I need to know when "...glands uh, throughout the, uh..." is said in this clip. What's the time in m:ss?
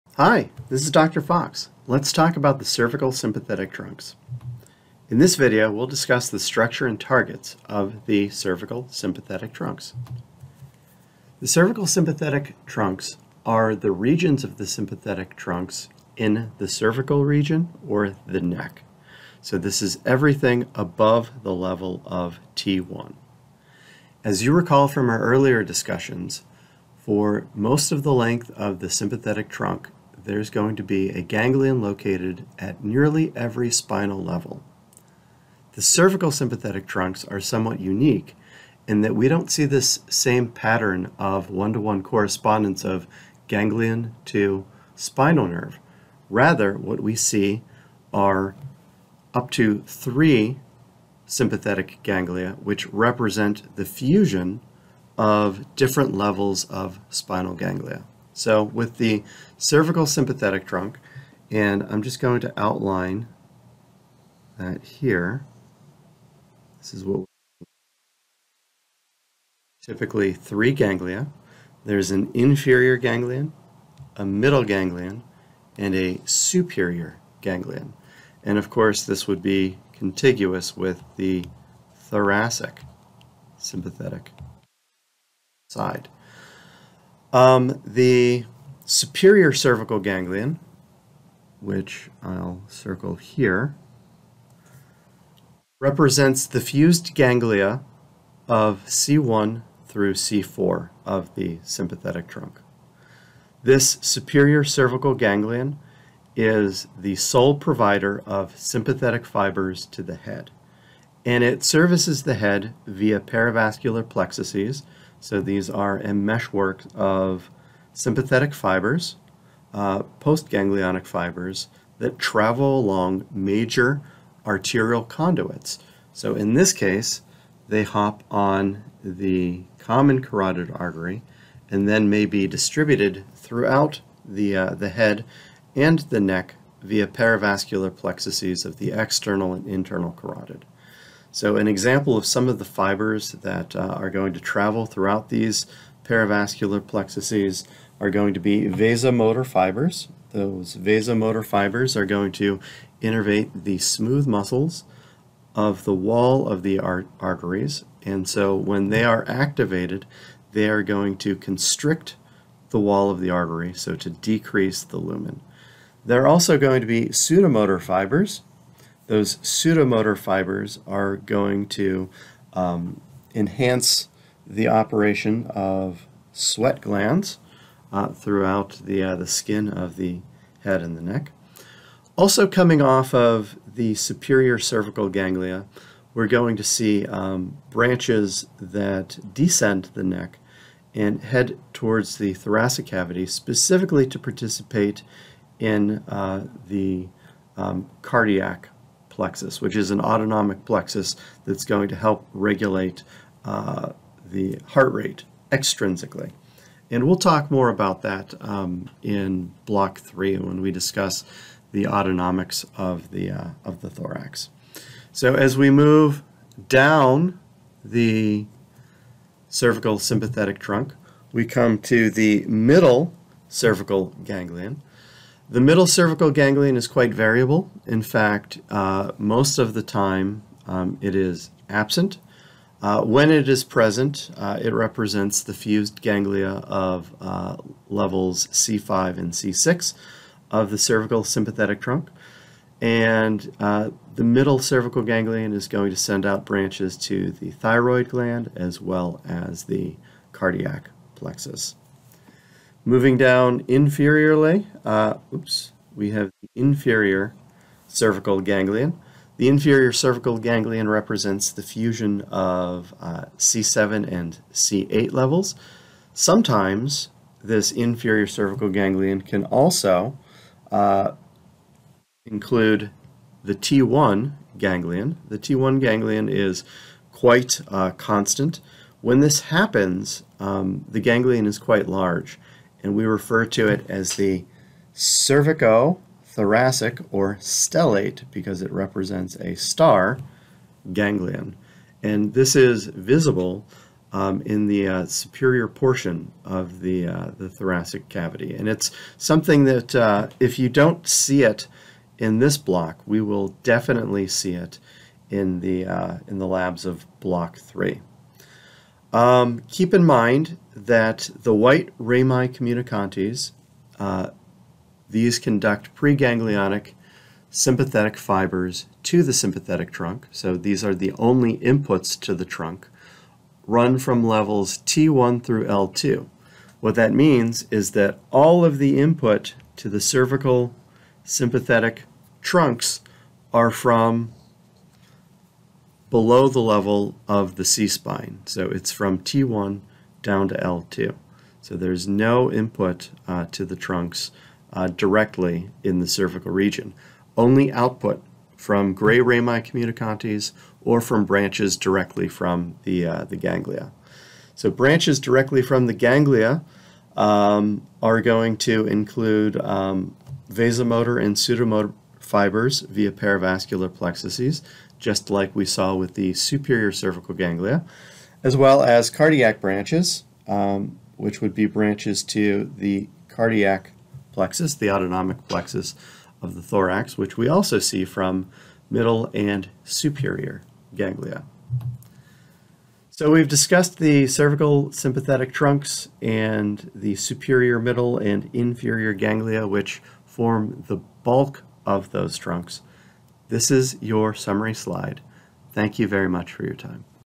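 2:56.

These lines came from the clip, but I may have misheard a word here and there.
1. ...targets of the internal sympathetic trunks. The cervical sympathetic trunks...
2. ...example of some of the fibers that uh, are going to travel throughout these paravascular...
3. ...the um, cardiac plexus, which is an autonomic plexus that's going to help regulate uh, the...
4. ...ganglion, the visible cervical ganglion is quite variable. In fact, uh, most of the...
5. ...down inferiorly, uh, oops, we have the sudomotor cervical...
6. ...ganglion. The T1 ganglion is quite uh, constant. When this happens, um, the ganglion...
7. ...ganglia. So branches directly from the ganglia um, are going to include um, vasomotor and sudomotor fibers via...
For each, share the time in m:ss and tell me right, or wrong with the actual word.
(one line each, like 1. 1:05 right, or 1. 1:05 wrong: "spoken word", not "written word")
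1. 0:07 wrong: "cervical", not "internal"
2. 2:21 right
3. 3:16 right
4. 3:44 wrong: "middle", not "visible"
5. 4:13 wrong: "inferior", not "sudomotor"
6. 4:34 right
7. 5:53 right.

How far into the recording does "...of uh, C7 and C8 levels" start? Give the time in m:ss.
4:22.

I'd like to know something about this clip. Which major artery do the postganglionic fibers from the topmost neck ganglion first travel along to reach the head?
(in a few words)
common carotid artery.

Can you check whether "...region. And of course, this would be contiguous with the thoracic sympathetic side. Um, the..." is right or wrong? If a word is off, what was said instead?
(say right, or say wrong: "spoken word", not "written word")
wrong: "ganglion", not "region".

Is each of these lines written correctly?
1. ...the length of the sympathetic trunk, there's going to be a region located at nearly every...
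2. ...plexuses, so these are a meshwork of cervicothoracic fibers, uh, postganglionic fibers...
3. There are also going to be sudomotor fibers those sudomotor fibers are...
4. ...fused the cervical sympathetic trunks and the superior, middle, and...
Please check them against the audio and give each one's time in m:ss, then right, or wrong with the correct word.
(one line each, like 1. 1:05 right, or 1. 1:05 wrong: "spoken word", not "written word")
1. 0:28 wrong: "ganglion", not "region"
2. 1:54 wrong: "sympathetic", not "cervicothoracic"
3. 2:46 right
4. 6:23 wrong: "discussed", not "fused".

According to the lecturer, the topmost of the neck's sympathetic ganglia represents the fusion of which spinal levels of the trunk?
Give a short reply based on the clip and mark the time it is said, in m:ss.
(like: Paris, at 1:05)
C1 through C4, at 1:38.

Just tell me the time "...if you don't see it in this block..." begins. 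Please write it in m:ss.
5:00.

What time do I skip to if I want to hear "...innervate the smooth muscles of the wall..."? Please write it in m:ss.
2:33.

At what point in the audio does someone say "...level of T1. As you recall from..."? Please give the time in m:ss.
0:21.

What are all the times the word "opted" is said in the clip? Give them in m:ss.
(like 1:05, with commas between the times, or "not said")
not said.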